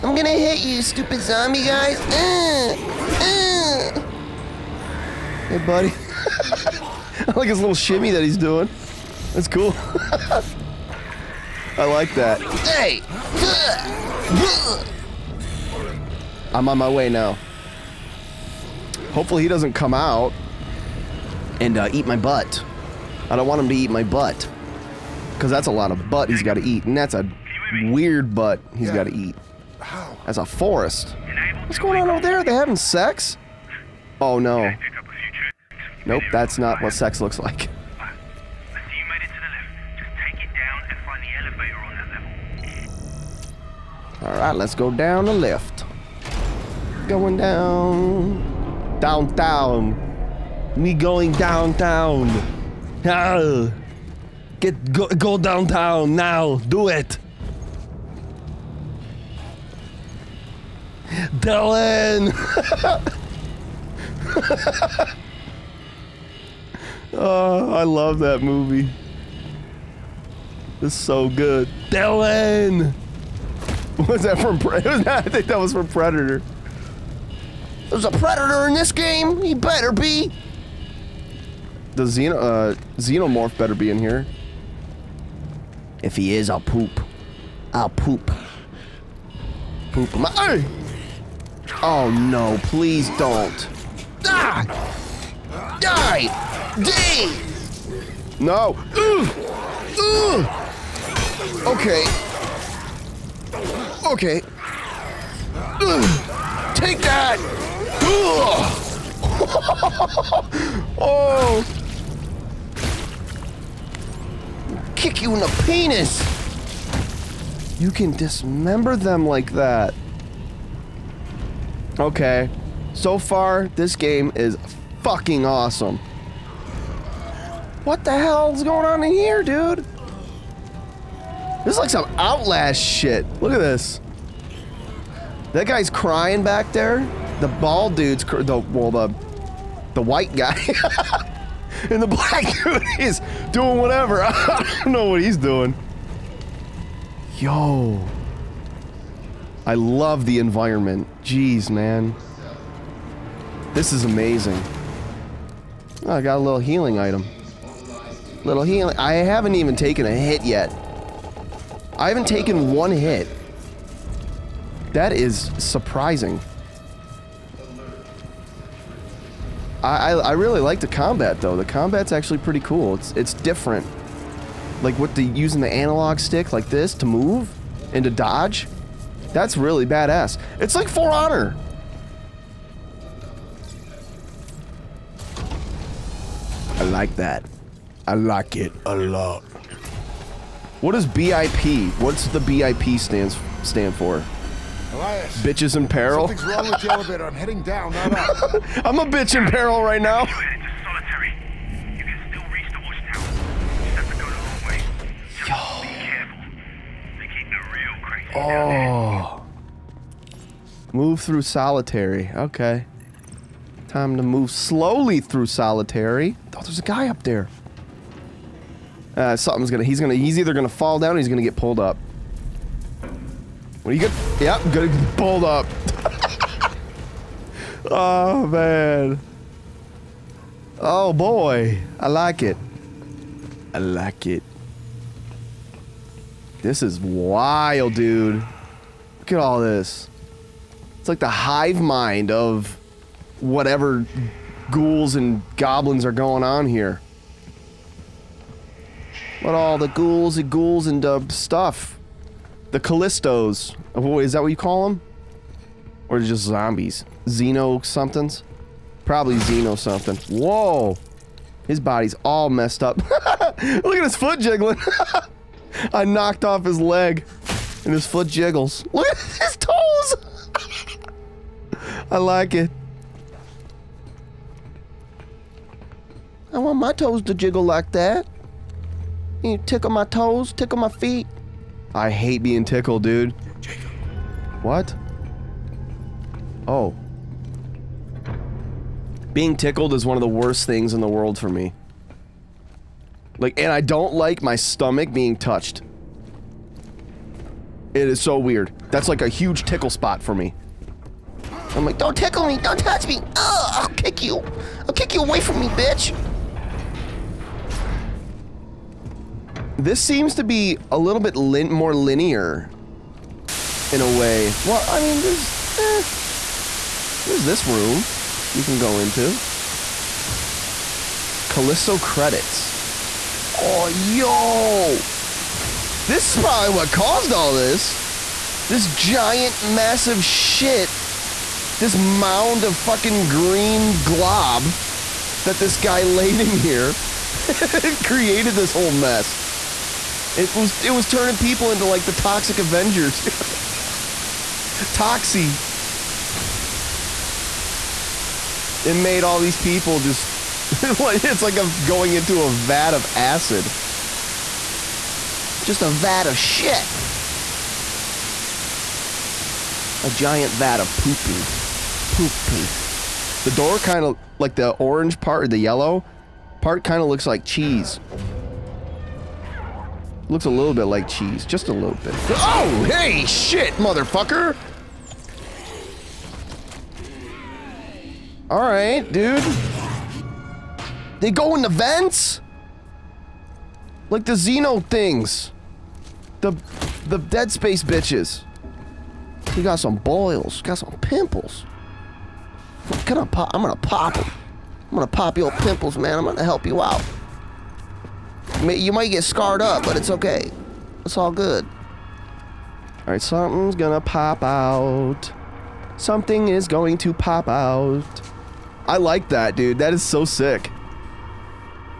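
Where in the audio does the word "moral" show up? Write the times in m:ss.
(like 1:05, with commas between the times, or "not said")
not said.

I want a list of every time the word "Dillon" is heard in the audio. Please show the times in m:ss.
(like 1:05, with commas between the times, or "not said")
1:01, 1:11.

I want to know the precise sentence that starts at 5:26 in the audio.
This is probably what caused all this.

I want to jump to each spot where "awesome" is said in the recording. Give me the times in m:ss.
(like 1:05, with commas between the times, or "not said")
2:05.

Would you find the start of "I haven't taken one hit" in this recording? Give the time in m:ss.
2:41.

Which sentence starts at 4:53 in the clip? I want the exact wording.
Like, and I don't like my stomach being touched.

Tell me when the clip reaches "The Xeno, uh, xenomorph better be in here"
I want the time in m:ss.
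1:21.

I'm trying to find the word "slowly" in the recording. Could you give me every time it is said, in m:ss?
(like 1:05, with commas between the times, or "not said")
3:34.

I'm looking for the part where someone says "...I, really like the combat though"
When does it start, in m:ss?
2:50.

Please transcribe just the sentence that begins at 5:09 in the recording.
This seems to be a little bit lin more linear in a way.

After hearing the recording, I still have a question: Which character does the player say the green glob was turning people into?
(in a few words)
The Toxic Avenger.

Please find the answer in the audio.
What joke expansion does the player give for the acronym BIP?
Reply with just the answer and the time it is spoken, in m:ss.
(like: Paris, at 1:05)
Bitches in peril, at 3:15.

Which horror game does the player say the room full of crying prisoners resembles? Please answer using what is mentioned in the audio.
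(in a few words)
Outlast.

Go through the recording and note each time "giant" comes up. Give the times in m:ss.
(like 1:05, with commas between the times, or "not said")
5:28, 6:00.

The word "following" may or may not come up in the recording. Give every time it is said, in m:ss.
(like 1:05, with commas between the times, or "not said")
not said.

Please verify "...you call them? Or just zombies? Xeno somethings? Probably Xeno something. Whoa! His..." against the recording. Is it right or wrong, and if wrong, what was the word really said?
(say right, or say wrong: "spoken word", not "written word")
right.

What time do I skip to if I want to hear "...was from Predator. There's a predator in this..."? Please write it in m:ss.
1:15.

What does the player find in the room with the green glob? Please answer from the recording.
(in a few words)
Callisto credits.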